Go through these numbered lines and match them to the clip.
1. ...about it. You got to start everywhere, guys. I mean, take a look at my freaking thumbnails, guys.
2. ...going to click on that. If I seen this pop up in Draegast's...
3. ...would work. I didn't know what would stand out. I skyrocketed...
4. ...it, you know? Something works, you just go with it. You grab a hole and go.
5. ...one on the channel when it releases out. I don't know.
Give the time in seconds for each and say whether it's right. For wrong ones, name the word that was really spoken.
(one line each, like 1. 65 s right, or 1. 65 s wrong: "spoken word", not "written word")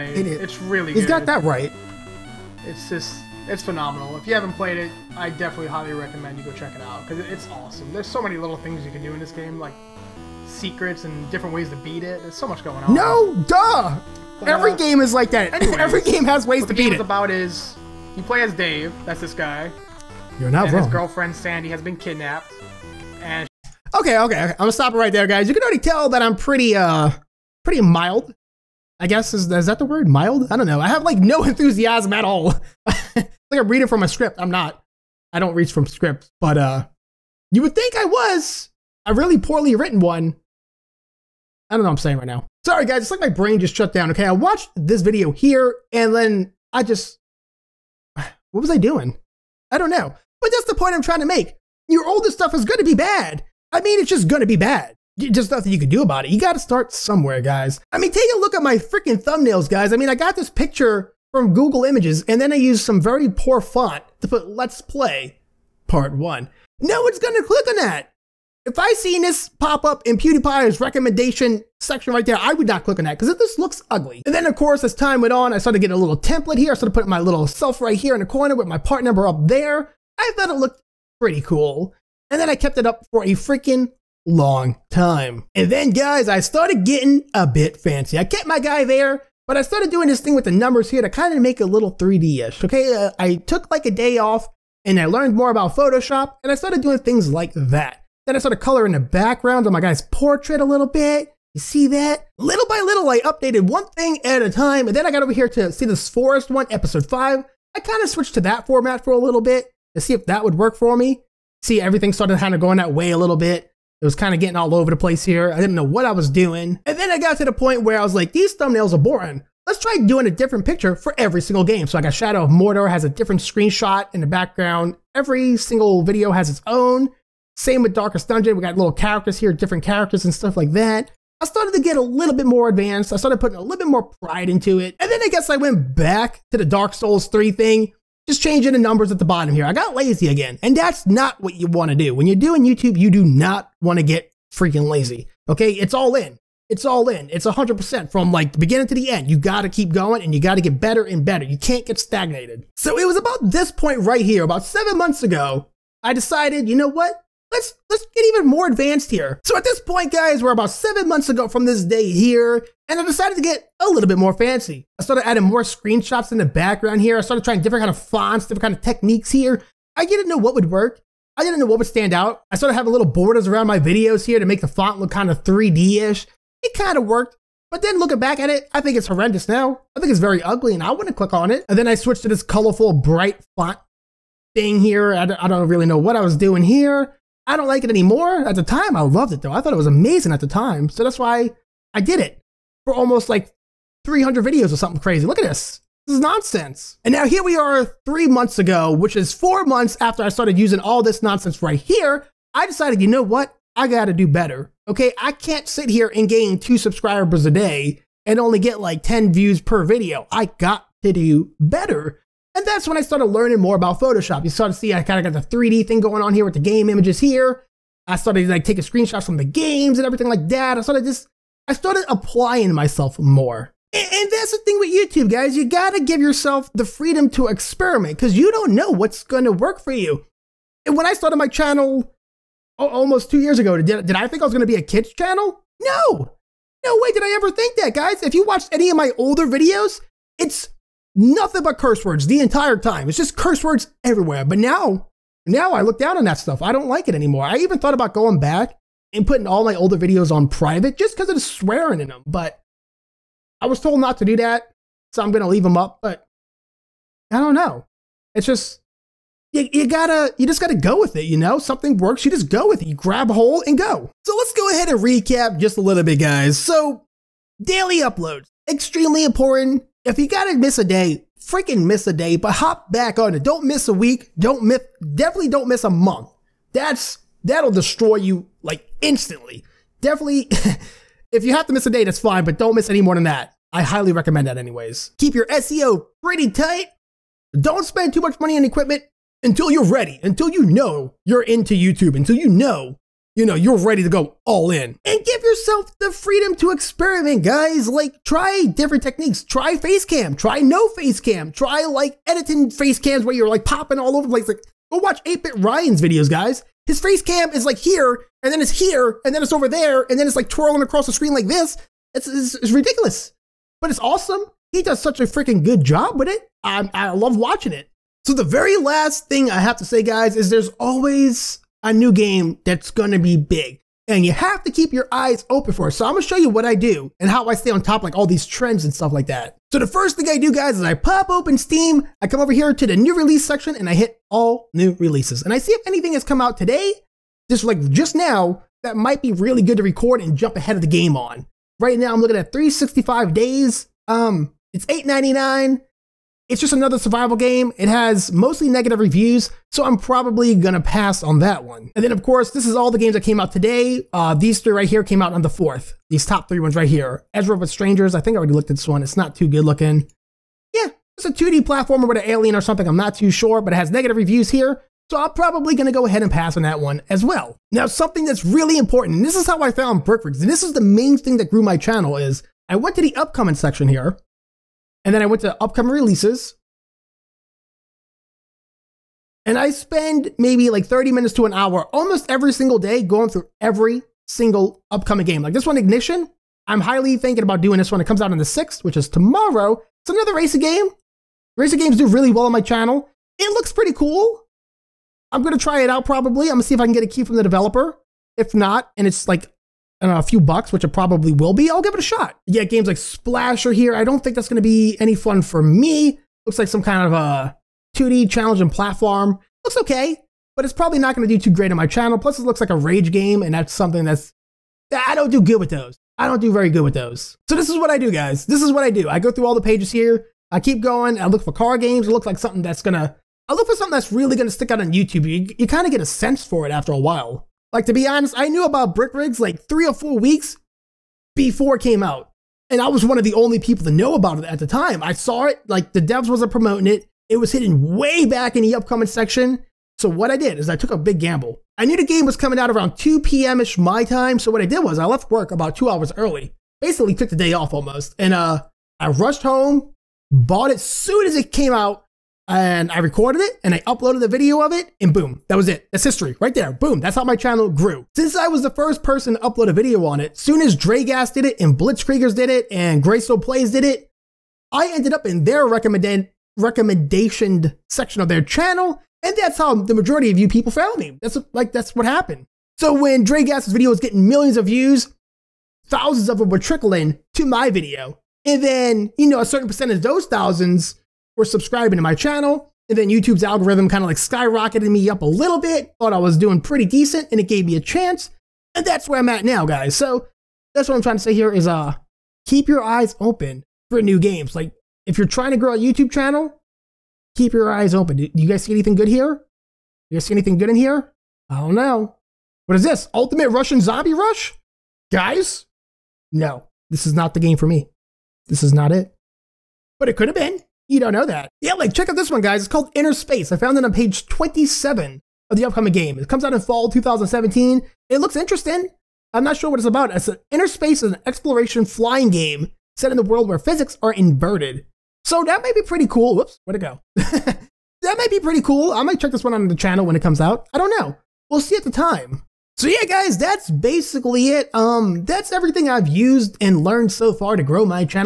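1. 56 s wrong: "somewhere", not "everywhere"
2. 67 s wrong: "PewDiePie", not "Draegast"
3. 170 s wrong: "started", not "skyrocketed"
4. 261 s right
5. 529 s wrong: "comes", not "releases".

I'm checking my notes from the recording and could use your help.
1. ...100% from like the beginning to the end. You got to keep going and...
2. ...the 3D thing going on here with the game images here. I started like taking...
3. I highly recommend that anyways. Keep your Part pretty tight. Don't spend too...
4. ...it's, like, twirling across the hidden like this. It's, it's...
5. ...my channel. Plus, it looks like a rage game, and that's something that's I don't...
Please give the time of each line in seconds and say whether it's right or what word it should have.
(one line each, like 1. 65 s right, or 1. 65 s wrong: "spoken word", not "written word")
1. 147 s right
2. 215 s right
3. 283 s wrong: "SEO", not "Part"
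4. 310 s wrong: "screen", not "hidden"
5. 411 s right.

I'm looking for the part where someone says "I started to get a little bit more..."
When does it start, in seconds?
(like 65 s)
131 s.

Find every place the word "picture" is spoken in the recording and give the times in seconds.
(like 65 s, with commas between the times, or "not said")
60 s, 120 s.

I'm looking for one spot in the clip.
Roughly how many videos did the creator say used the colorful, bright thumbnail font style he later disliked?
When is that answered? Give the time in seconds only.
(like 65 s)
194 s.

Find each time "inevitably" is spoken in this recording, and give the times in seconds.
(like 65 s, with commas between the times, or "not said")
not said.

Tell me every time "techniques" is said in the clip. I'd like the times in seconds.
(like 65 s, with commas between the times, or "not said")
168 s, 299 s.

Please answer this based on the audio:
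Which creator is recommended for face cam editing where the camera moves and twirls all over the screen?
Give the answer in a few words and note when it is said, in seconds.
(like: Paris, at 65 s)
8-Bit Ryan, at 305 s.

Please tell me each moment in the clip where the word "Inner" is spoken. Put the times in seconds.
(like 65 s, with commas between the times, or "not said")
512 s, 520 s.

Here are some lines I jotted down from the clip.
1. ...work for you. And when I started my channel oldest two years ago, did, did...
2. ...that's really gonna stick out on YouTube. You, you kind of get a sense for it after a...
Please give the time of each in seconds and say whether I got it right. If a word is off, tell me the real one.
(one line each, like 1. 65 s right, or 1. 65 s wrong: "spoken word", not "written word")
1. 229 s wrong: "almost", not "oldest"
2. 423 s right.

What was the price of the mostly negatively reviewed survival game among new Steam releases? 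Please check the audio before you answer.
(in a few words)
8.99.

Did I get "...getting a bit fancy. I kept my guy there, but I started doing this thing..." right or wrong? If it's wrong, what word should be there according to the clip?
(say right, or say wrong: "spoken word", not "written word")
right.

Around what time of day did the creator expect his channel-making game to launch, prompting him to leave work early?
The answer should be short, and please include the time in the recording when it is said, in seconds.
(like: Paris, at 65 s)
2 p.m., at 442 s.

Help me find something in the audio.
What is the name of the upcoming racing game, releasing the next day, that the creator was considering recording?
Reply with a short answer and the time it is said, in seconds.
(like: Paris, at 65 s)
Ignition, at 385 s.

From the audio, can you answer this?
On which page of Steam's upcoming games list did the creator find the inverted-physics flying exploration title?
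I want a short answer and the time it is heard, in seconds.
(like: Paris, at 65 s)
27, at 513 s.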